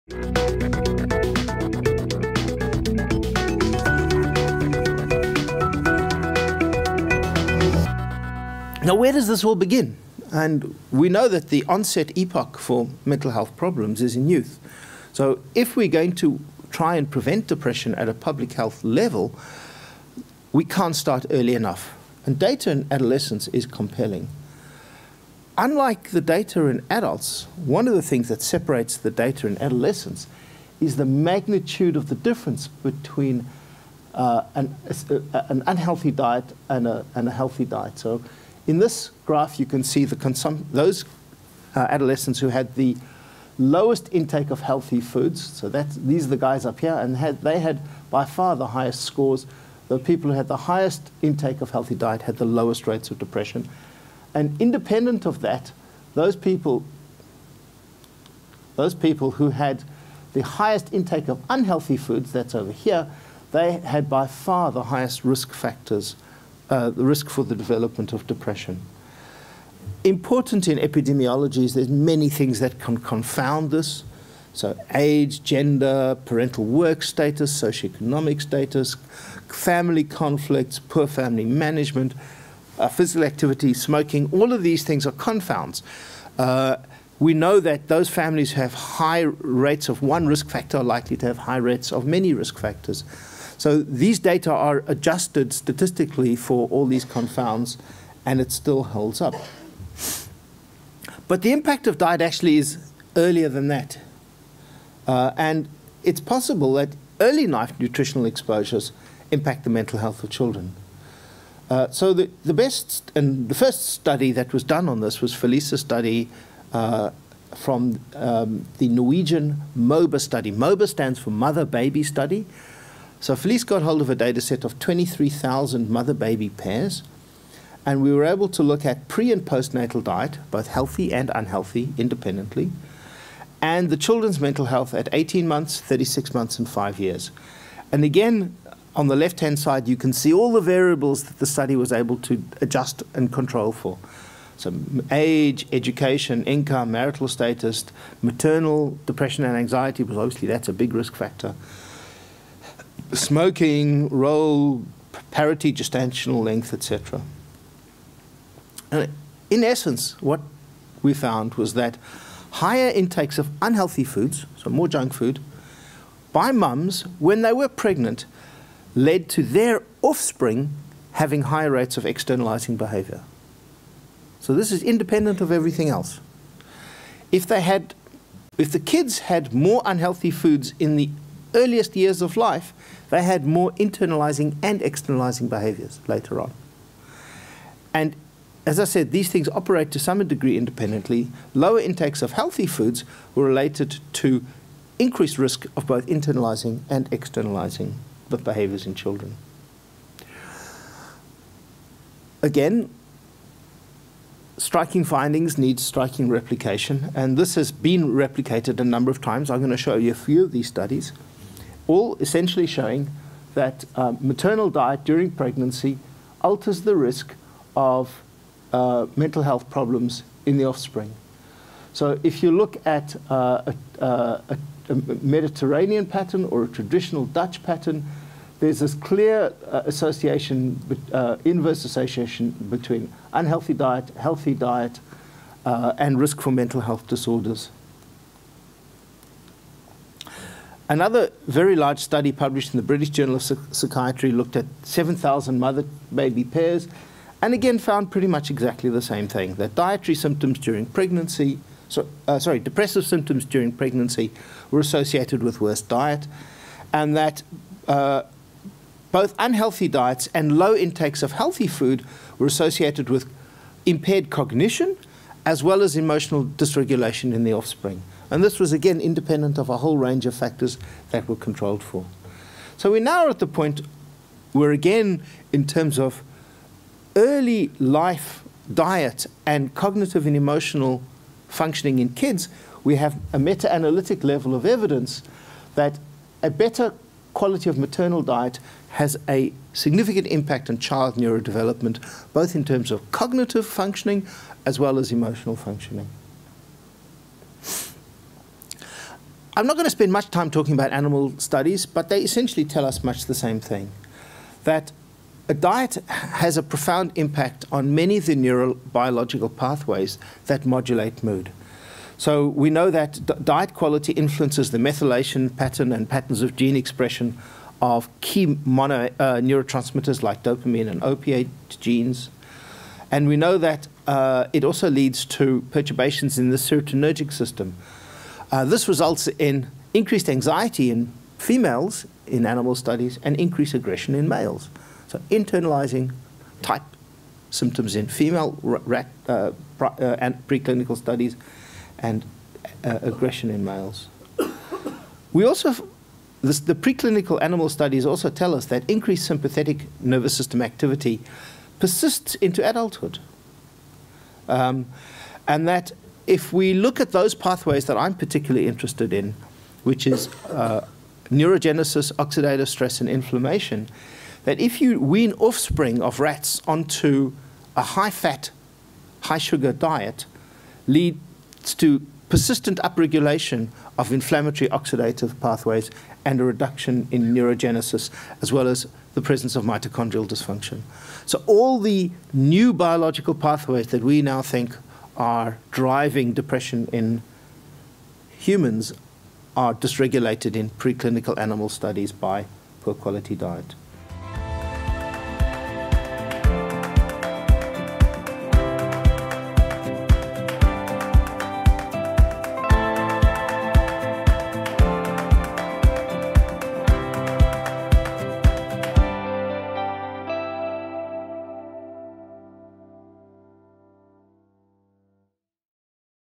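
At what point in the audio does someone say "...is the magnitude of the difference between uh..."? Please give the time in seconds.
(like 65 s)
30 s.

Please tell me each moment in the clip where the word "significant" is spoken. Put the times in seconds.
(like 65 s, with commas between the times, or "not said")
289 s.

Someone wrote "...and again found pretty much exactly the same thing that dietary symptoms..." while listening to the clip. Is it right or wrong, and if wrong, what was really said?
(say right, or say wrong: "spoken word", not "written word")
right.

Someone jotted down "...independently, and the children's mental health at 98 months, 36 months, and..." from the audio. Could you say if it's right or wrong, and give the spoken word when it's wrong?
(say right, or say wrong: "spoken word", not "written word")
wrong: "18", not "98".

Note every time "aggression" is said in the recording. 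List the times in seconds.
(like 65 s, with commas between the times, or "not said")
333 s, 343 s.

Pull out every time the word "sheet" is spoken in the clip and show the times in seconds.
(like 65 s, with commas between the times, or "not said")
not said.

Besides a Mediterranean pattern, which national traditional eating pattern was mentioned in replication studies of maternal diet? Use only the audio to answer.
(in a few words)
traditional Dutch pattern.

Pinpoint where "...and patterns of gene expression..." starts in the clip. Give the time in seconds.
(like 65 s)
315 s.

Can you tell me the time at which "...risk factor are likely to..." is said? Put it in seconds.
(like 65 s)
90 s.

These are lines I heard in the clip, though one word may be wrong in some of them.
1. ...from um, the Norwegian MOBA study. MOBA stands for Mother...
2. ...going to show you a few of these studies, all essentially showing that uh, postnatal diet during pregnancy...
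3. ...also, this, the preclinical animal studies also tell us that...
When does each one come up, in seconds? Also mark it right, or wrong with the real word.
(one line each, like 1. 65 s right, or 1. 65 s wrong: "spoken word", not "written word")
1. 117 s right
2. 209 s wrong: "maternal", not "postnatal"
3. 345 s right.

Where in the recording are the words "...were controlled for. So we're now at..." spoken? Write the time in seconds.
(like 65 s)
271 s.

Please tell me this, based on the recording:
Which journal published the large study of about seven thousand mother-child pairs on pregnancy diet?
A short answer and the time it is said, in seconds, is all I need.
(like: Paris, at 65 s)
British Journal of Psychiatry, at 242 s.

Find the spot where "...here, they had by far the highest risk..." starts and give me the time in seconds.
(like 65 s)
62 s.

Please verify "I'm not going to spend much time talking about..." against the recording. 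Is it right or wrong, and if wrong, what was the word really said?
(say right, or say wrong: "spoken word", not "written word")
right.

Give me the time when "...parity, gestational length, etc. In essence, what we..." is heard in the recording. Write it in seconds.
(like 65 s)
155 s.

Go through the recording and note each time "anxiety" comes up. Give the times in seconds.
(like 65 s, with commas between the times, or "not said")
149 s, 330 s.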